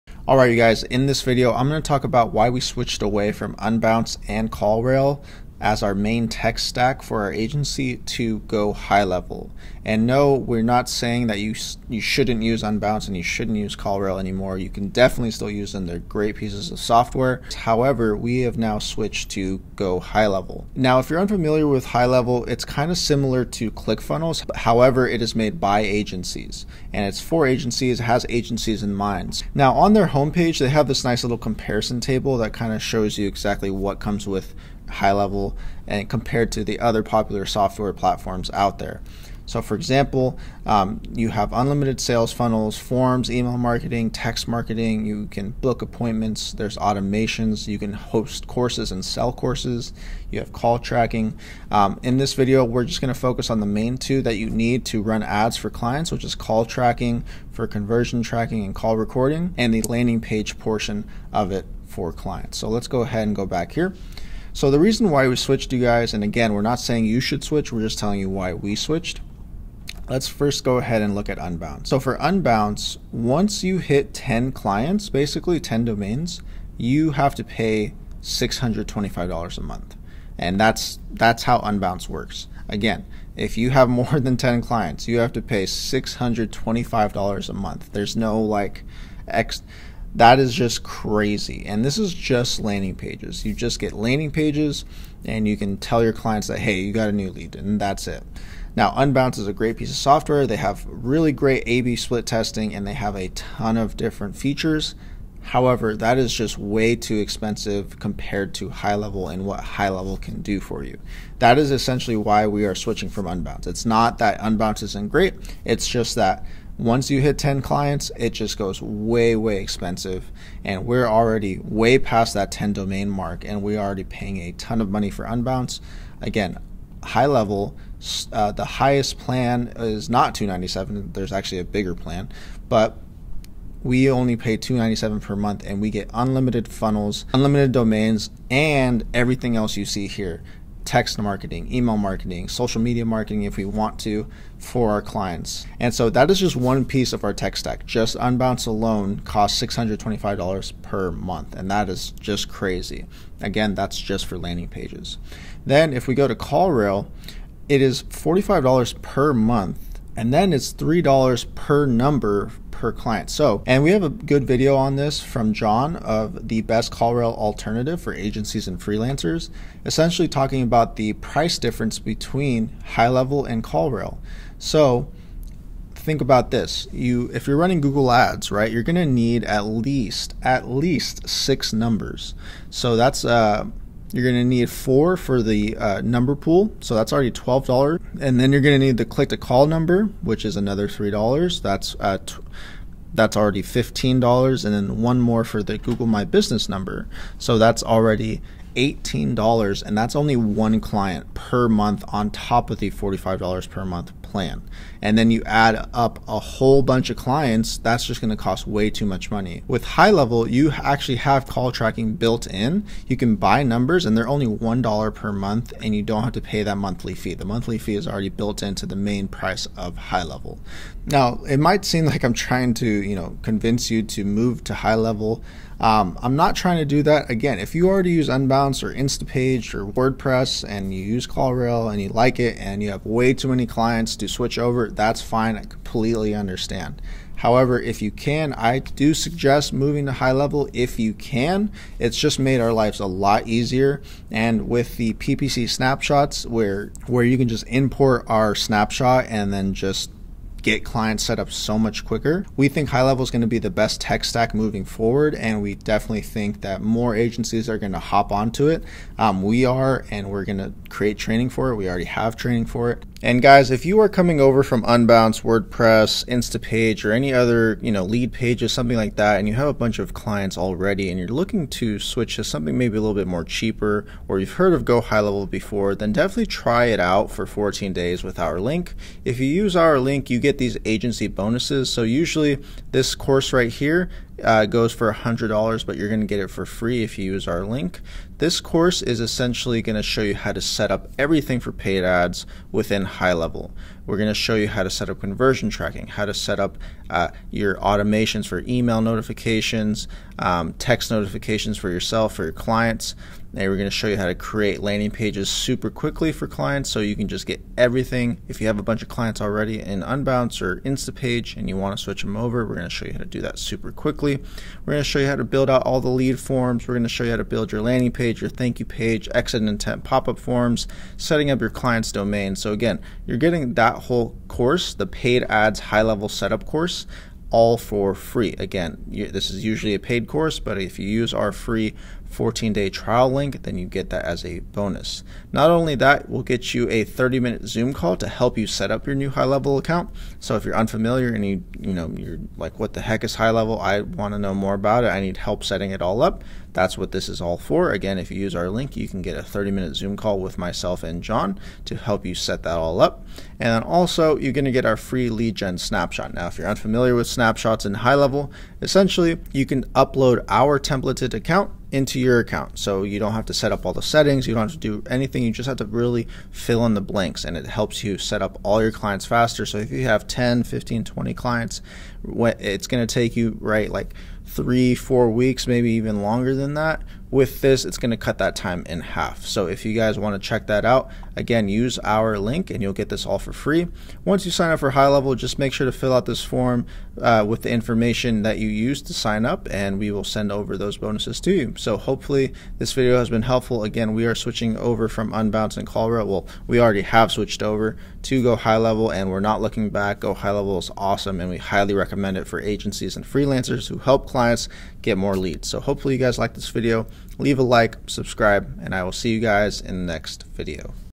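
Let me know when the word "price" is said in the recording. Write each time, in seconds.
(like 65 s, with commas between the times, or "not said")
171 s, 219 s.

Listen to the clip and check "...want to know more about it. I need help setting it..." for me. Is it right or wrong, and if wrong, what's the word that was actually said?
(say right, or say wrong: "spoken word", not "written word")
right.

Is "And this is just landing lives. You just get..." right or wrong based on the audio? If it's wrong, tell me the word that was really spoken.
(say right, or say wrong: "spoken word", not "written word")
wrong: "pages", not "lives".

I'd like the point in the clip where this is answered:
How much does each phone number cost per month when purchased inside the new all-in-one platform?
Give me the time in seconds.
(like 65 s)
214 s.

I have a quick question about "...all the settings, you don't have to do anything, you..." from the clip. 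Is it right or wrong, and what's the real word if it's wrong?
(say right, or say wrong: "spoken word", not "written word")
right.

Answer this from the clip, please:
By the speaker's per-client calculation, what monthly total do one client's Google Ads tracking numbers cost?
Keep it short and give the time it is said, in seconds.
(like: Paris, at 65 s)
$18, at 198 s.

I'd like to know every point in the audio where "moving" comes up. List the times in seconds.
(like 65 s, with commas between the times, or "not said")
239 s, 254 s.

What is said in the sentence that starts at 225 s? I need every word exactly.
Um, I'm not trying to do that.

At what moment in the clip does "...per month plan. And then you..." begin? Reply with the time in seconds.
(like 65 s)
203 s.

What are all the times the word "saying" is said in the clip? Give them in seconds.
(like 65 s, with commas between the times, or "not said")
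10 s, 66 s.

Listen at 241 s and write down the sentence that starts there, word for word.
It's just made our lives a lot easier.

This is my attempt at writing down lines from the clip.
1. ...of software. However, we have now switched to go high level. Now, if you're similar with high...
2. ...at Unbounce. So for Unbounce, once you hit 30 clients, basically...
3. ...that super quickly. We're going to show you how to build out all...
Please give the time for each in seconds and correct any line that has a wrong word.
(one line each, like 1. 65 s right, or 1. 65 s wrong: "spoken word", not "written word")
1. 16 s wrong: "unfamiliar", not "similar"
2. 71 s wrong: "10", not "30"
3. 313 s right.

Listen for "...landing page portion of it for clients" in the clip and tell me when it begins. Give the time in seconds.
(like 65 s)
59 s.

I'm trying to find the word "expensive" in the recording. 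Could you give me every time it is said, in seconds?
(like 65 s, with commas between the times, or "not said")
107 s, 119 s.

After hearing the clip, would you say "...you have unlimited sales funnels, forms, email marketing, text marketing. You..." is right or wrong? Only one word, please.
right.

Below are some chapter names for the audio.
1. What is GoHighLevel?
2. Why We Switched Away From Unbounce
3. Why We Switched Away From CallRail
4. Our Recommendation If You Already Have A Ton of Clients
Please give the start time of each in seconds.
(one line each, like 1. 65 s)
1. 23 s
2. 65 s
3. 155 s
4. 221 s.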